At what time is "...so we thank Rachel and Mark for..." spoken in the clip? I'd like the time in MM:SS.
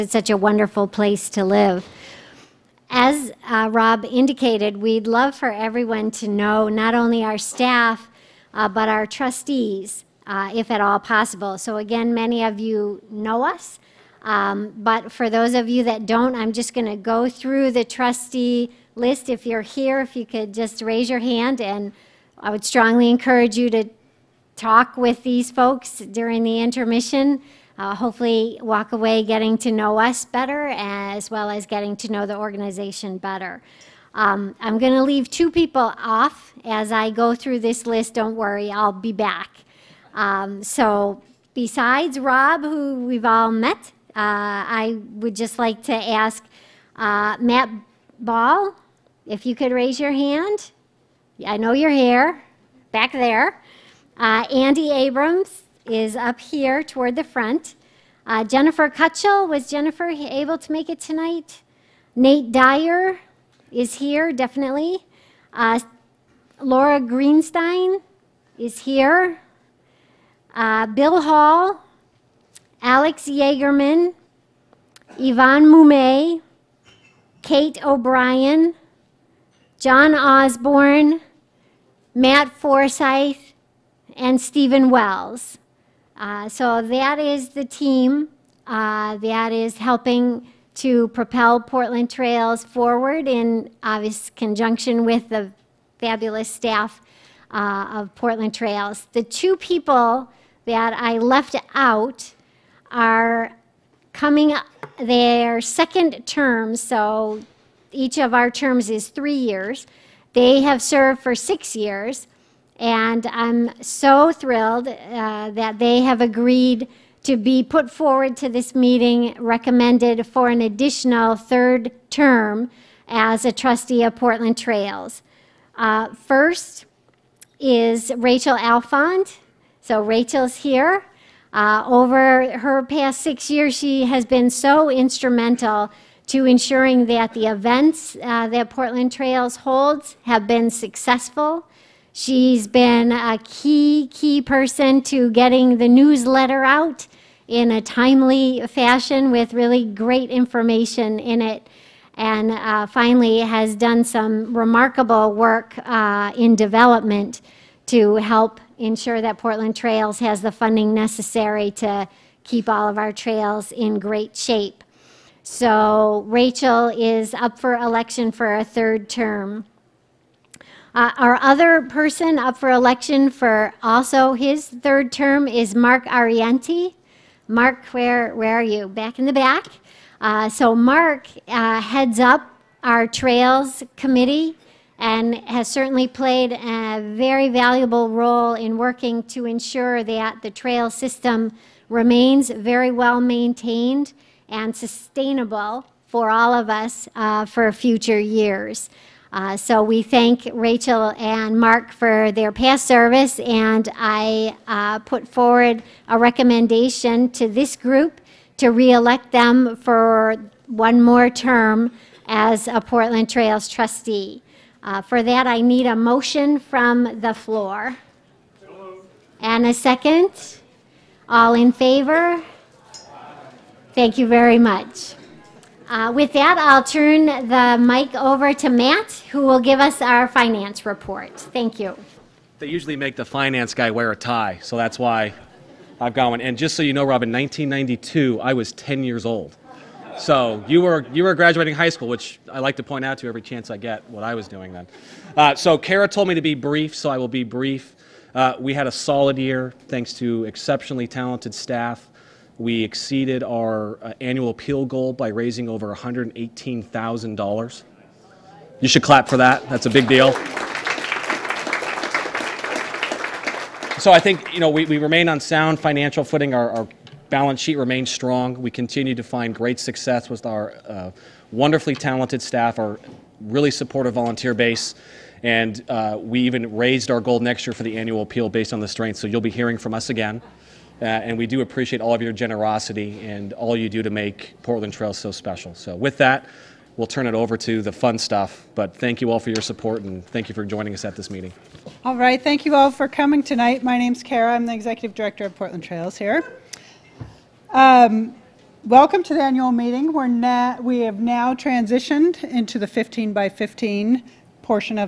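03:19.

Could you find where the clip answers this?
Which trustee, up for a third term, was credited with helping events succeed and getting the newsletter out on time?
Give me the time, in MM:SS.
02:08.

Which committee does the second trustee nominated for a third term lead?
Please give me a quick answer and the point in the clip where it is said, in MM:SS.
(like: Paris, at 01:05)
trails committee, at 03:03.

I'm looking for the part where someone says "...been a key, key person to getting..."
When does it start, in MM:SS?
02:22.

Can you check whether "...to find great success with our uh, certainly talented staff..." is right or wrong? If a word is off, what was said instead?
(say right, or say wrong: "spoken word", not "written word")
wrong: "wonderfully", not "certainly".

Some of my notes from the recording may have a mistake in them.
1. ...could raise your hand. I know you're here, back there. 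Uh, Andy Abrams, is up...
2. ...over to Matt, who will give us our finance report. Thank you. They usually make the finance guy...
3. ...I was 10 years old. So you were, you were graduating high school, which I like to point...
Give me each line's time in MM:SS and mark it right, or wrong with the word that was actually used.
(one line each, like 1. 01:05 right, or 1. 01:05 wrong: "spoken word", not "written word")
1. 00:49 right
2. 03:48 right
3. 03:58 right.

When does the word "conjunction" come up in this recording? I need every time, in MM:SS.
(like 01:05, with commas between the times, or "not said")
01:34.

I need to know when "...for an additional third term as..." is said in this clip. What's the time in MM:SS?
02:00.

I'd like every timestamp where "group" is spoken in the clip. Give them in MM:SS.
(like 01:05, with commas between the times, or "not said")
03:27.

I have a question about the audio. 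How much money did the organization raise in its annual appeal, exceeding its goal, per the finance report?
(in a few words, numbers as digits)
Over $118,000.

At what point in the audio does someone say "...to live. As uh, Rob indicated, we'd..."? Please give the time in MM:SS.
00:01.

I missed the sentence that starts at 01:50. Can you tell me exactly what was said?
They have served for six years.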